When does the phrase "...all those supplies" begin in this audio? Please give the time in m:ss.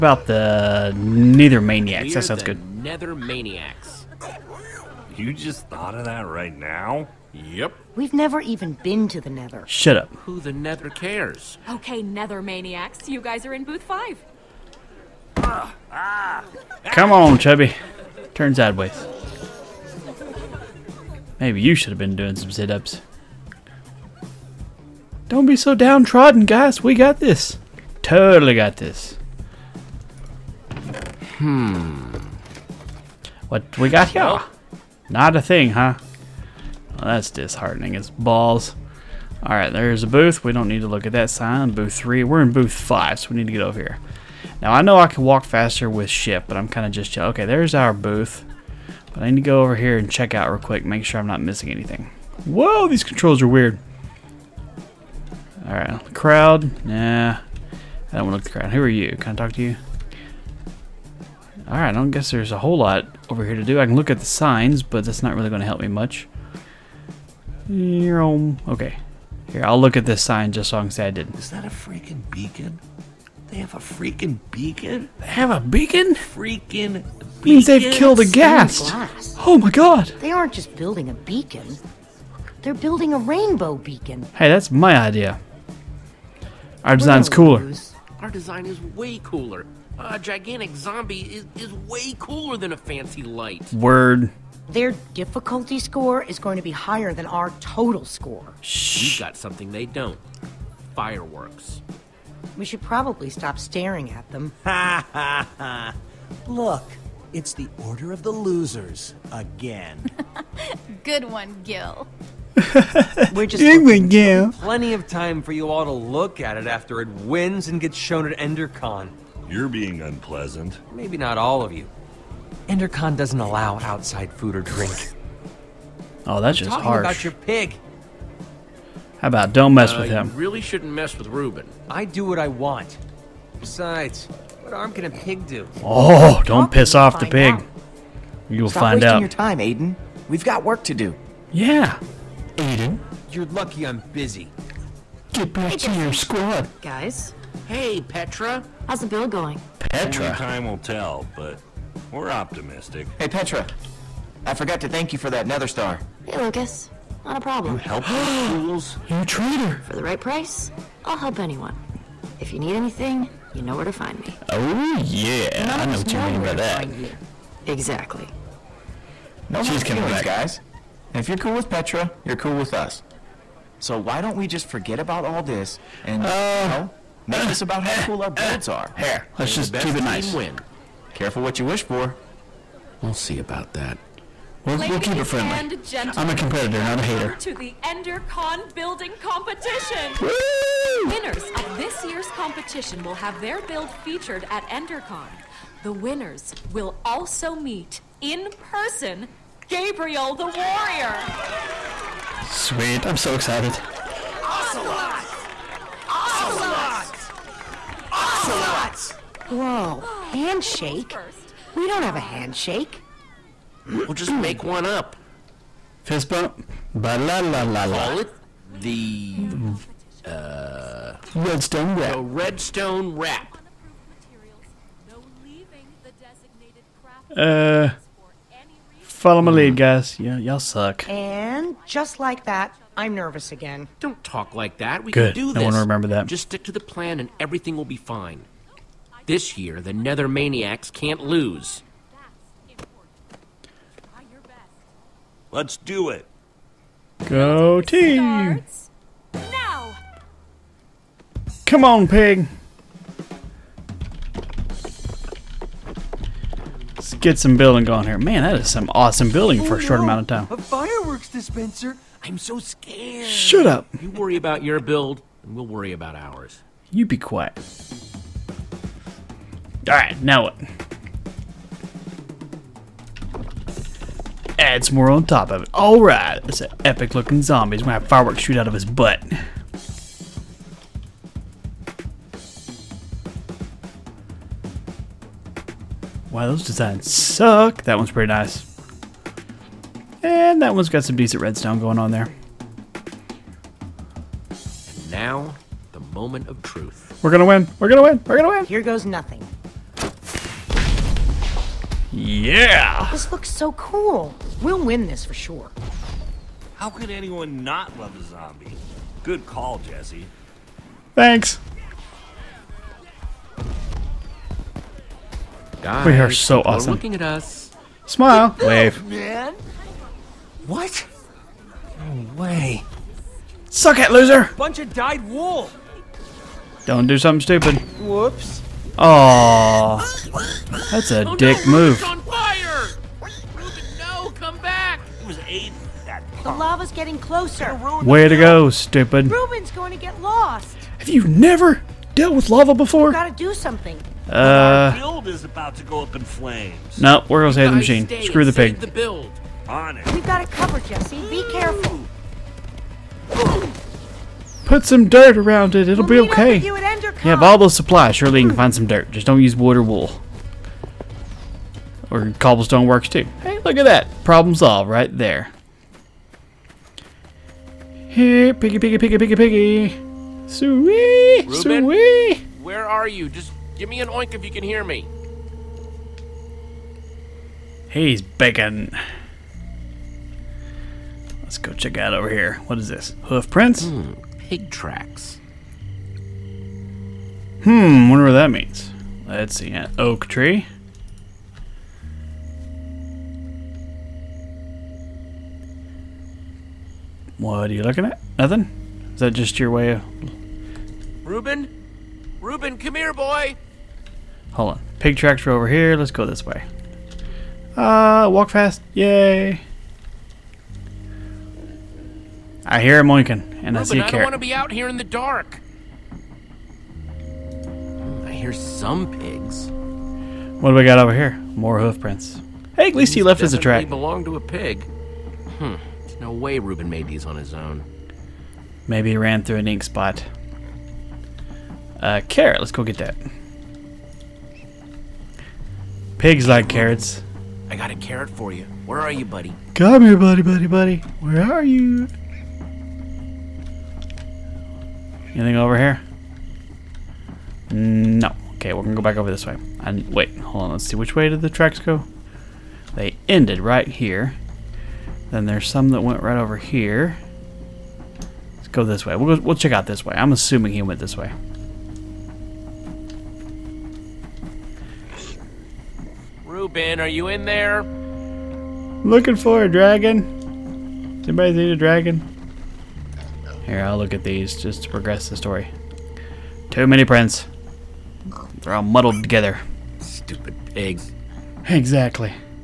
5:57.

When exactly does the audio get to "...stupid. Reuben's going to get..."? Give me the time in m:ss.
5:38.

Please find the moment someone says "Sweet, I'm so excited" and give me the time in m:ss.
3:22.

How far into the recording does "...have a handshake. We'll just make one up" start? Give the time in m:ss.
3:32.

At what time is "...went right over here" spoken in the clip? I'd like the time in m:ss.
7:36.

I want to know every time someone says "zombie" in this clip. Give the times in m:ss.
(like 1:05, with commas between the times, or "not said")
1:30, 4:37, 5:08.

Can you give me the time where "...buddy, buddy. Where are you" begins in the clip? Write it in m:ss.
7:20.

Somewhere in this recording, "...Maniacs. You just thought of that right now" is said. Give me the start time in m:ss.
0:03.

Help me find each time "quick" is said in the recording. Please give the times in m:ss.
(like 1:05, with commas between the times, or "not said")
0:50.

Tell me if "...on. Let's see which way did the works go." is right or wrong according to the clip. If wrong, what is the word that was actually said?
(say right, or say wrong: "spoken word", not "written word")
wrong: "tracks", not "works".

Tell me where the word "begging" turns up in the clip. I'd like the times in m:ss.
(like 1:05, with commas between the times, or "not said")
6:18.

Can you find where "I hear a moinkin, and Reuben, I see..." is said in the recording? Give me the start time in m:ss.
6:52.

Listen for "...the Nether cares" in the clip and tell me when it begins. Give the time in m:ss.
0:10.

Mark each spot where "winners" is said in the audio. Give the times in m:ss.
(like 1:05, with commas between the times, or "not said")
3:11, 3:15.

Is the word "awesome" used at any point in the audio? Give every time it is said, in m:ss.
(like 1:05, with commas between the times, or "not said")
4:18, 5:16.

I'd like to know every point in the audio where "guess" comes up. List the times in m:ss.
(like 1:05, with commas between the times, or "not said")
1:02.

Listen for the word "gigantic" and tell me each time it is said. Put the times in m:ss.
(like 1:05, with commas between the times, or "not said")
1:30.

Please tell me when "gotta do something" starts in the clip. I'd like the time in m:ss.
5:43.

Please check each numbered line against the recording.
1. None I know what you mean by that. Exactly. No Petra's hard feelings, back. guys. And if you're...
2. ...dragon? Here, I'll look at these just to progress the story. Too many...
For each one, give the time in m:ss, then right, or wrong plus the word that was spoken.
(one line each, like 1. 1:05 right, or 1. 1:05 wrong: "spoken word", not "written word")
1. 2:45 wrong: "She", not "Petra"
2. 7:51 right.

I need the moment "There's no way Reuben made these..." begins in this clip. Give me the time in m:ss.
7:05.